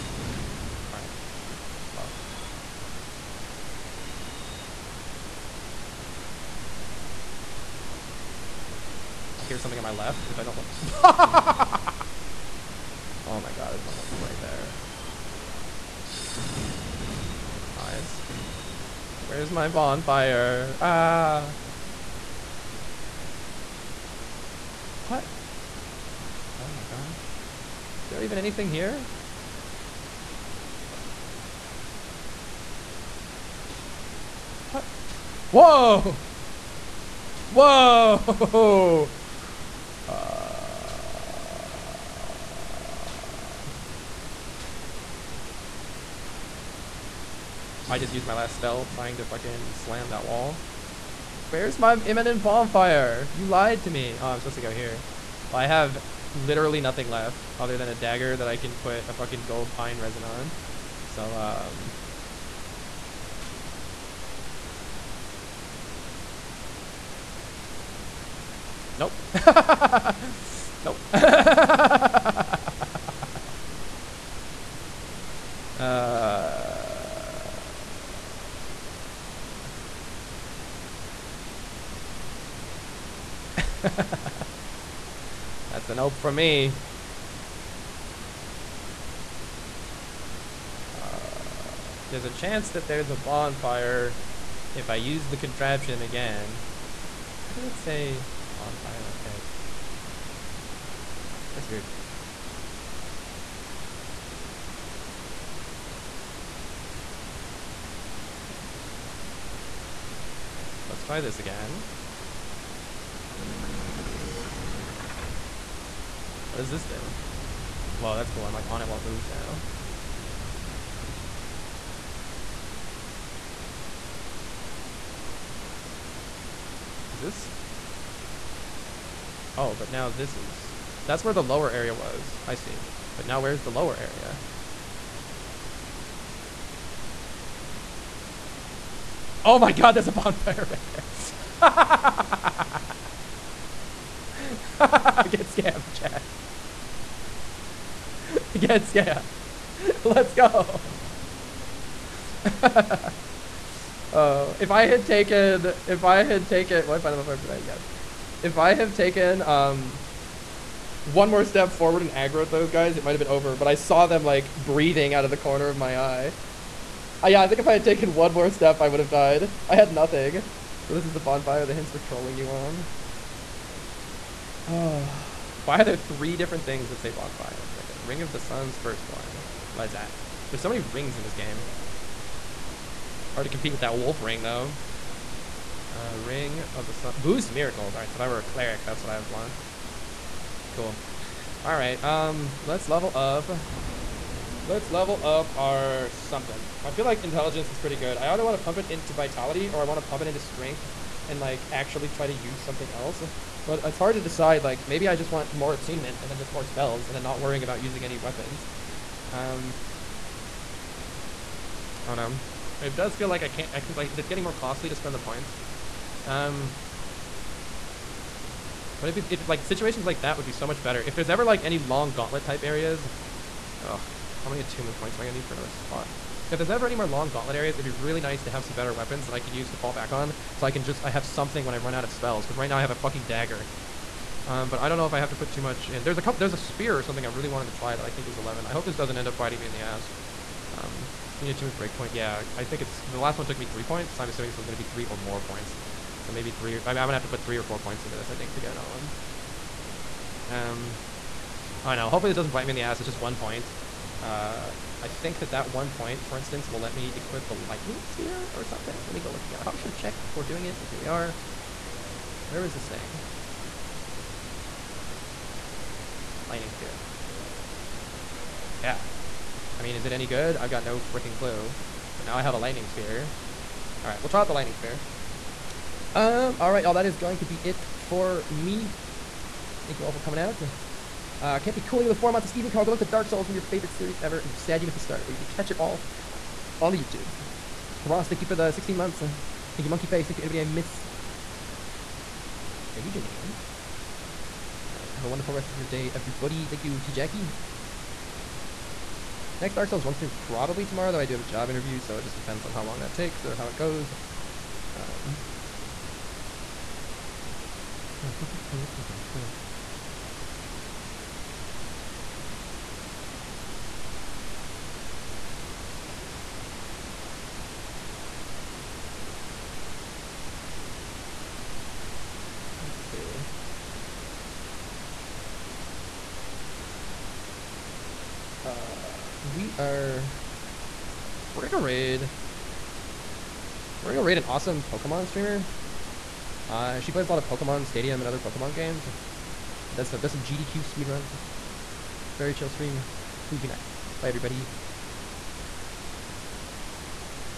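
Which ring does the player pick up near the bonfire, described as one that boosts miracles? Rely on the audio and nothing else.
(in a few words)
Ring of the Sun's Firstborn.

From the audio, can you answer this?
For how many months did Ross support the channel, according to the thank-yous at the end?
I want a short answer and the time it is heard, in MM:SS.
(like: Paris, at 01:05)
16, at 04:48.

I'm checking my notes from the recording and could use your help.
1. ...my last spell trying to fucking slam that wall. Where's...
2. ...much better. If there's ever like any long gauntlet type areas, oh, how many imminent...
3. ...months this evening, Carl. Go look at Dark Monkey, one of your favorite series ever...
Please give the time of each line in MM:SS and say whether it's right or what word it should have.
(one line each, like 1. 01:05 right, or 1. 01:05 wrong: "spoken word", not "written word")
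1. 00:48 right
2. 03:40 wrong: "attunement", not "imminent"
3. 04:42 wrong: "Souls", not "Monkey".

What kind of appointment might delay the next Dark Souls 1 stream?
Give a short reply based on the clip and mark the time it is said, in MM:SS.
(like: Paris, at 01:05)
job interview, at 05:01.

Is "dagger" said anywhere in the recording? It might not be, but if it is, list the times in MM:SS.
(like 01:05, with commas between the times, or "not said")
00:57, 03:53.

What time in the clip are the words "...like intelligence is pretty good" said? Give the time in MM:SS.
03:17.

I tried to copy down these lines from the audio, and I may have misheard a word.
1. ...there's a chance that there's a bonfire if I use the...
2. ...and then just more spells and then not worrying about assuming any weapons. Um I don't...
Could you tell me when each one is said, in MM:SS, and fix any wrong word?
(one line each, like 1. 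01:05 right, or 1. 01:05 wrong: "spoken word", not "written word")
1. 01:32 right
2. 03:26 wrong: "using", not "assuming".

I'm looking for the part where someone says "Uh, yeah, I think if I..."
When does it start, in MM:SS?
02:47.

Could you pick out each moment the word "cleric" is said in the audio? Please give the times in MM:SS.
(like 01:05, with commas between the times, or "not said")
03:08.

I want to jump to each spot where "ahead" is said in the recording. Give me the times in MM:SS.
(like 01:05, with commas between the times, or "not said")
01:39.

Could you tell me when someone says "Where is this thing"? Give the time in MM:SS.
04:22.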